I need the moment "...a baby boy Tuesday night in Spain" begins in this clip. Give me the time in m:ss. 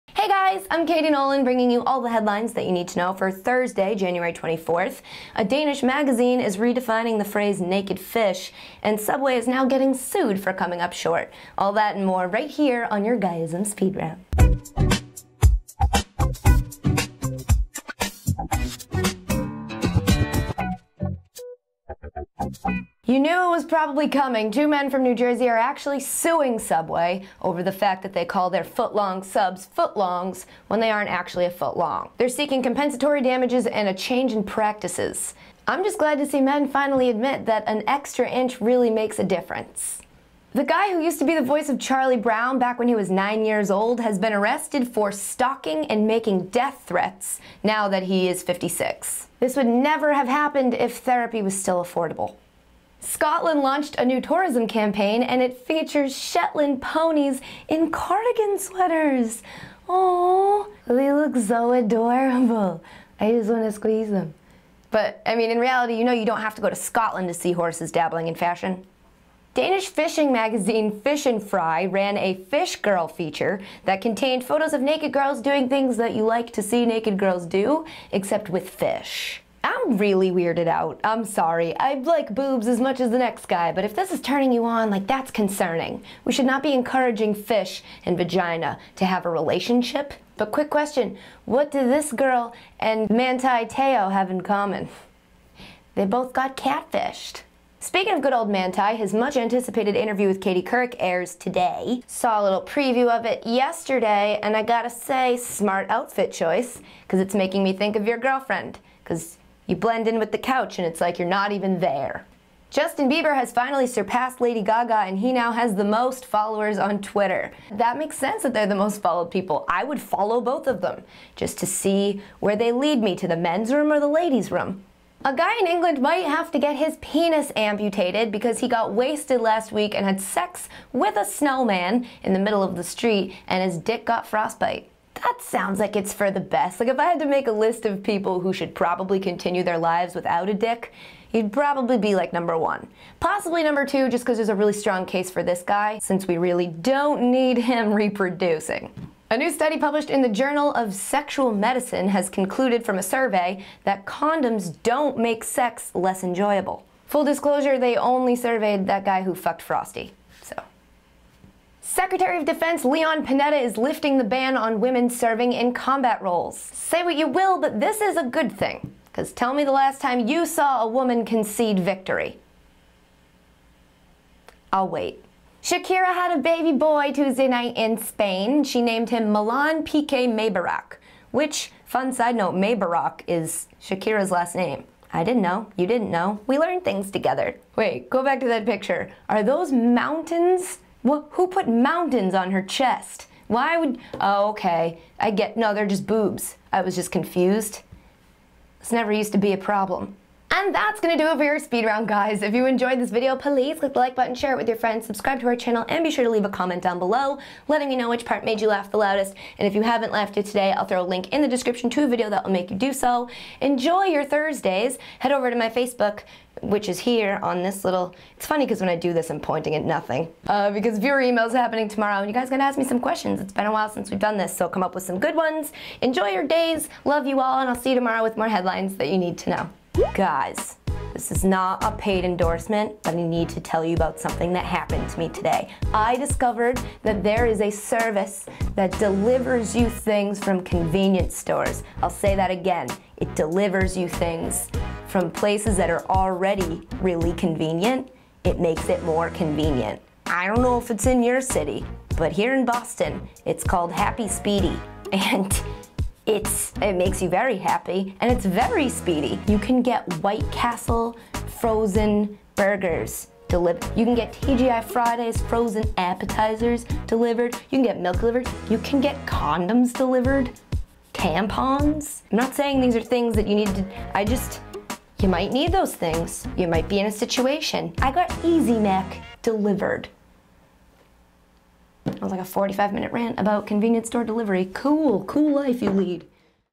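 2:56.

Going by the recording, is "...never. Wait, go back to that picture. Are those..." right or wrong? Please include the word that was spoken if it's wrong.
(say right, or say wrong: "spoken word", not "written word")
wrong: "together", not "never".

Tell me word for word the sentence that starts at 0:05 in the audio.
A Danish magazine is redefining the phrase naked fish, and Subway is now getting sued for coming up short.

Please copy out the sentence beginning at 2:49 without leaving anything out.
Because tell me the last time you saw a woman concede victory.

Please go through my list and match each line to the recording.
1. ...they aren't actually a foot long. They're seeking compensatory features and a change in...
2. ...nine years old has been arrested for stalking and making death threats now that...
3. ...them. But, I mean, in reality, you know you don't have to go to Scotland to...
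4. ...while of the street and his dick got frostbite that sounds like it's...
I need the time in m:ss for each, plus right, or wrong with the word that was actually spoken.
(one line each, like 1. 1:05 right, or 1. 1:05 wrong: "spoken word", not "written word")
1. 0:30 wrong: "damages", not "features"
2. 0:43 right
3. 1:04 right
4. 2:12 wrong: "middle", not "while".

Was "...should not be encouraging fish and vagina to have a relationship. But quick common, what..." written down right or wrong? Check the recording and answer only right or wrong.
wrong.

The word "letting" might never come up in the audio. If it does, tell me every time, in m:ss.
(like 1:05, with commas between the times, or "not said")
3:27.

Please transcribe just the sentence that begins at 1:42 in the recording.
Saw a little preview of it yesterday, and I gotta say, smart outfit choice, because it's making me think of your girlfriend.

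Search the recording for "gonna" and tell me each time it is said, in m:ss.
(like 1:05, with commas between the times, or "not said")
3:20, 3:42.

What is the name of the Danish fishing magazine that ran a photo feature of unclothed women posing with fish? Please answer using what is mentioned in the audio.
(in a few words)
Fish and Fry.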